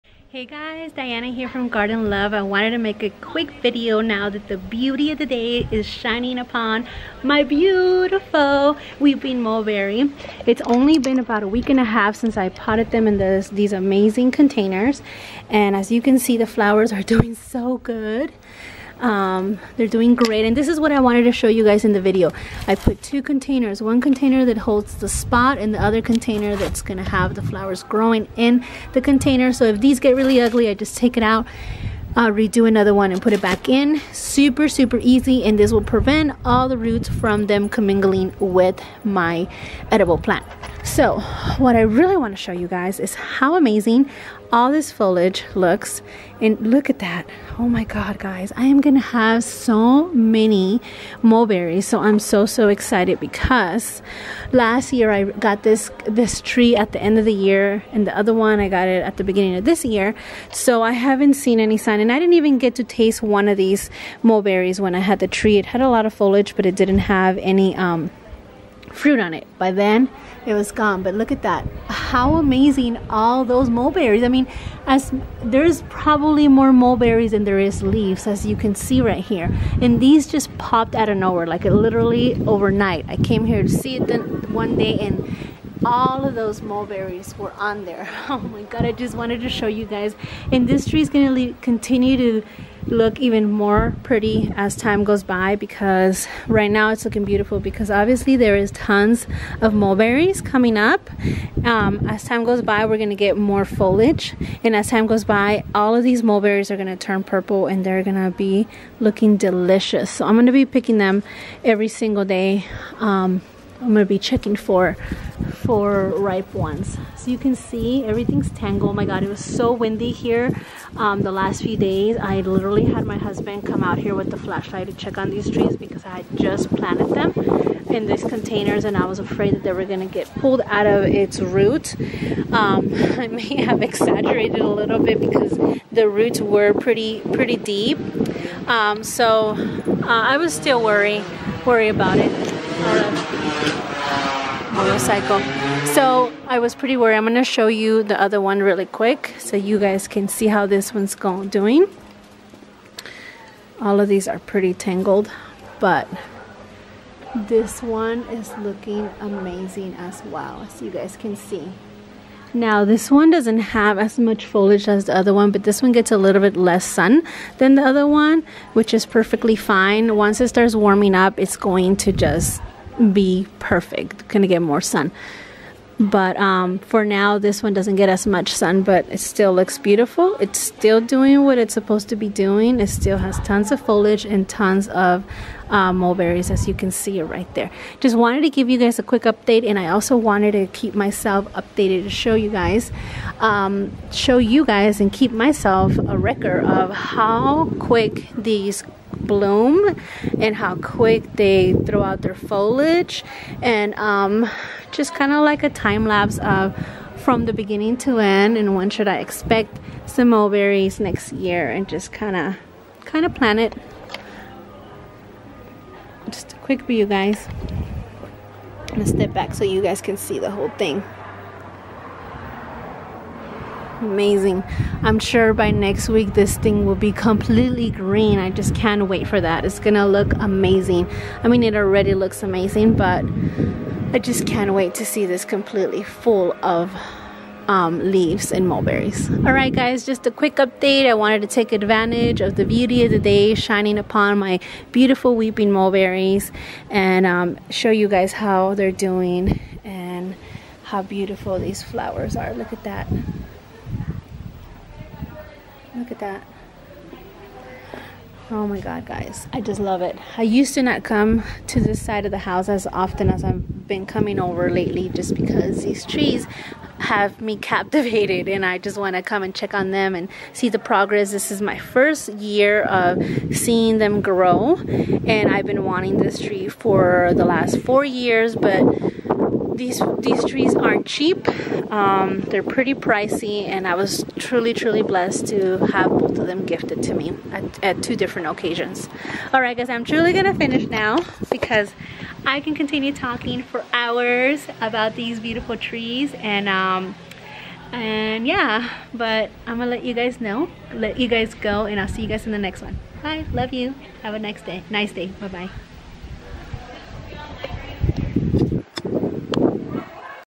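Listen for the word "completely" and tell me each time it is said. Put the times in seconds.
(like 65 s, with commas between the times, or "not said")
227 s, 235 s.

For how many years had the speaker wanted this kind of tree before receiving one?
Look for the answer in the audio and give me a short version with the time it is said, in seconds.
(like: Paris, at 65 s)
4 years, at 277 s.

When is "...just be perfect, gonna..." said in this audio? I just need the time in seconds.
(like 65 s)
172 s.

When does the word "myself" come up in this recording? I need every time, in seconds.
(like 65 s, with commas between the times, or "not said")
190 s, 195 s.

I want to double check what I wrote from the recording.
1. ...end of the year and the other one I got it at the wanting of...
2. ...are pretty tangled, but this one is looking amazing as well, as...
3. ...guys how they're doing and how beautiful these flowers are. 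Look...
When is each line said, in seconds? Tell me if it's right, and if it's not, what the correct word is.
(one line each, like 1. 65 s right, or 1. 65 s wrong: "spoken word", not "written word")
1. 57 s wrong: "beginning", not "wanting"
2. 154 s right
3. 248 s right.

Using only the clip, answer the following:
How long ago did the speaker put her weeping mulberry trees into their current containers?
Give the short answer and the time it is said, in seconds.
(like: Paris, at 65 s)
A week and a half, at 11 s.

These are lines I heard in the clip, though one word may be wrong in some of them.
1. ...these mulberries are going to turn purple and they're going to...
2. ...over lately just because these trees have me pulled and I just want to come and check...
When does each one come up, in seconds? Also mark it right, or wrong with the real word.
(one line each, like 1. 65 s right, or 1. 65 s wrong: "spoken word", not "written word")
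1. 106 s right
2. 264 s wrong: "captivated", not "pulled".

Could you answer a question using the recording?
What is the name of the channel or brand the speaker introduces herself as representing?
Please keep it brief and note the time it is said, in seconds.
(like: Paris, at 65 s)
Garden Love, at 1 s.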